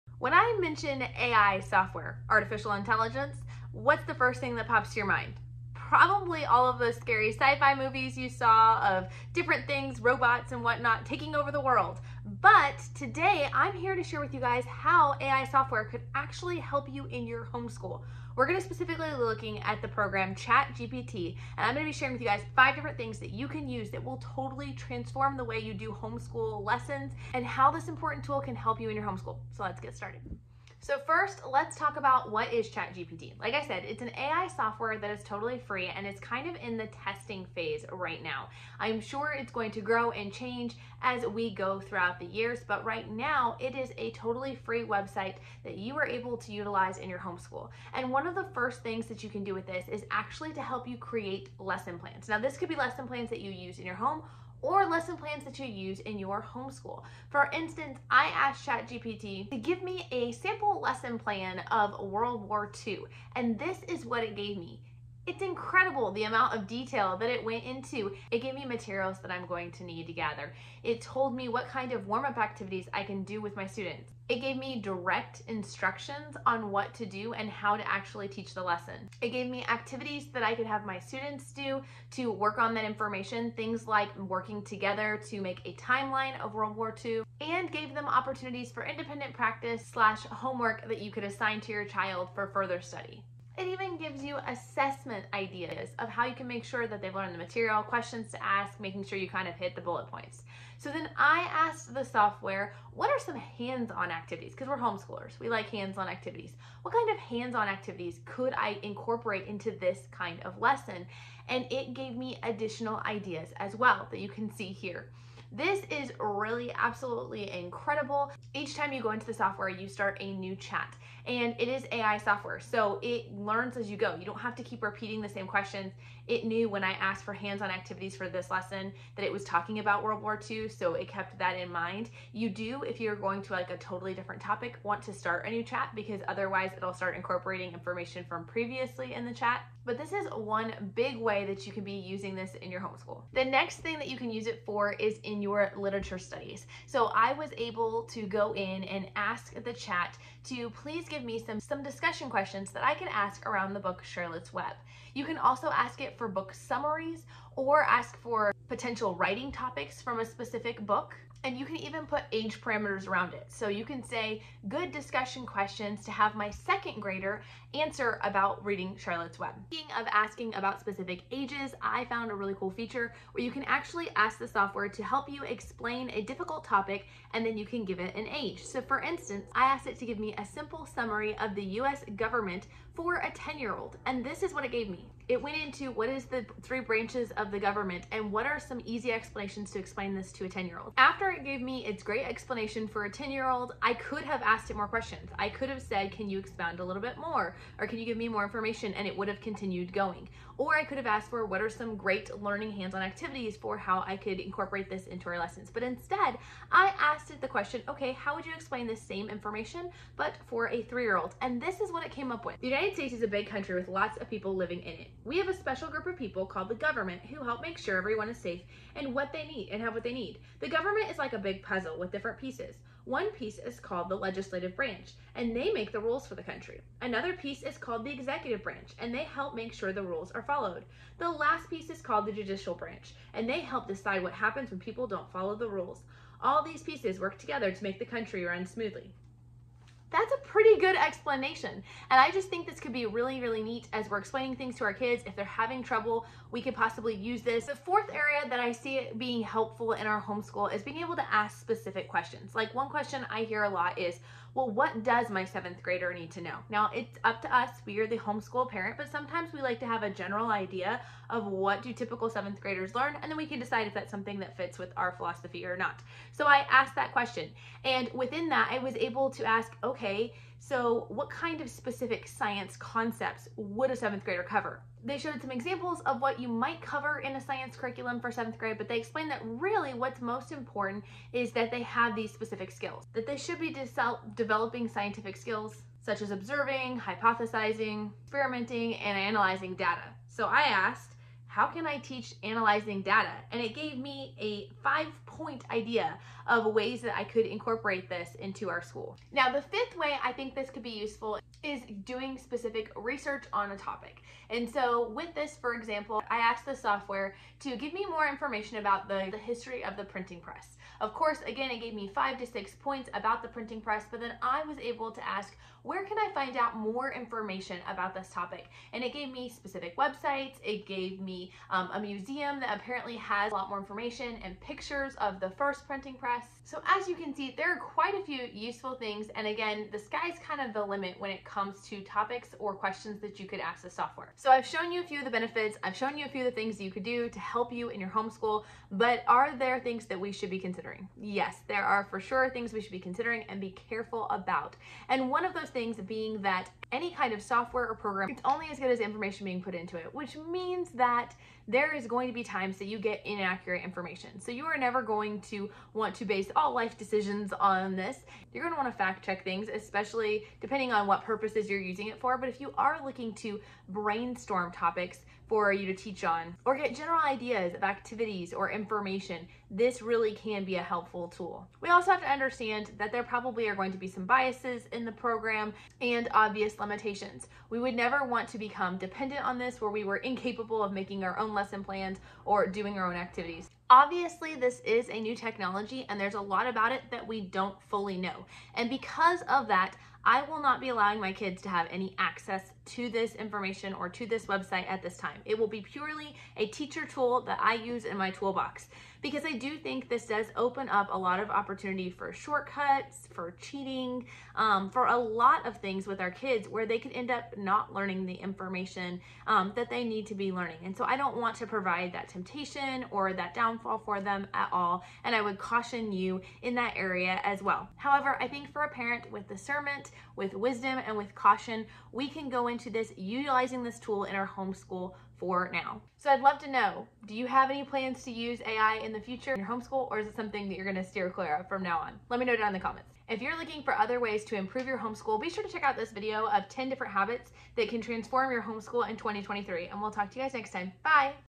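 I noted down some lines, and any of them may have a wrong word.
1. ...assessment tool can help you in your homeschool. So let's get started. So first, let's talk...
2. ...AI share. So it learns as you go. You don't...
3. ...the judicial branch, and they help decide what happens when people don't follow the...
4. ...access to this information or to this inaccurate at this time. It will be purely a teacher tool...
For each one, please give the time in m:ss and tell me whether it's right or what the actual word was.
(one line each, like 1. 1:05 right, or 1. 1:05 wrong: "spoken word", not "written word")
1. 0:27 wrong: "important", not "assessment"
2. 2:01 wrong: "software", not "share"
3. 3:52 right
4. 6:32 wrong: "website", not "inaccurate".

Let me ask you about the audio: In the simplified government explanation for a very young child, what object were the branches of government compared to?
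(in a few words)
A big puzzle.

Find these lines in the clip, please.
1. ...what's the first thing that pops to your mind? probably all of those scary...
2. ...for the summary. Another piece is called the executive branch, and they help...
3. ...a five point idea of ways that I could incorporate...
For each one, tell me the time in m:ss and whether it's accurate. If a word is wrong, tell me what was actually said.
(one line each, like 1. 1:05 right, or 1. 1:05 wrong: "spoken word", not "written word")
1. 0:03 right
2. 3:46 wrong: "country", not "summary"
3. 4:54 right.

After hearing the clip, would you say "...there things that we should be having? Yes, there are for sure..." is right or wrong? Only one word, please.
wrong.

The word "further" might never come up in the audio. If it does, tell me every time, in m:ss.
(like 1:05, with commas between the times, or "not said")
1:32.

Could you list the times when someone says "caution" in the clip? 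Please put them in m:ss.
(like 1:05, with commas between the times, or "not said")
6:55, 7:01.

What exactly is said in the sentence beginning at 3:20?
Or I could have asked for what are some great learning hands-on activities for how I could incorporate this into our lessons.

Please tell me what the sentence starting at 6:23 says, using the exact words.
Obviously, this is a new technology and there's a lot about it that we don't fully know.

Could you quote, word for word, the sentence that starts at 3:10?
After it gave me its great explanation for a 10 year old, I could have asked it more questions.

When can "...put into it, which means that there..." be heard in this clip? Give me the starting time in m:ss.
5:49.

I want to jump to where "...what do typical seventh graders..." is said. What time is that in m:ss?
4:21.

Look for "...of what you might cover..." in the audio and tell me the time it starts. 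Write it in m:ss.
4:36.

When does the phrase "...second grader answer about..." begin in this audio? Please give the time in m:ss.
2:46.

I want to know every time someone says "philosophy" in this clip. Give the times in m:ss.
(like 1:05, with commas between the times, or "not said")
4:25.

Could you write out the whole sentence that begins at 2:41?
And you can even put age parameters around it.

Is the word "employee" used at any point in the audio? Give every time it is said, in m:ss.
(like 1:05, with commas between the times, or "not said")
not said.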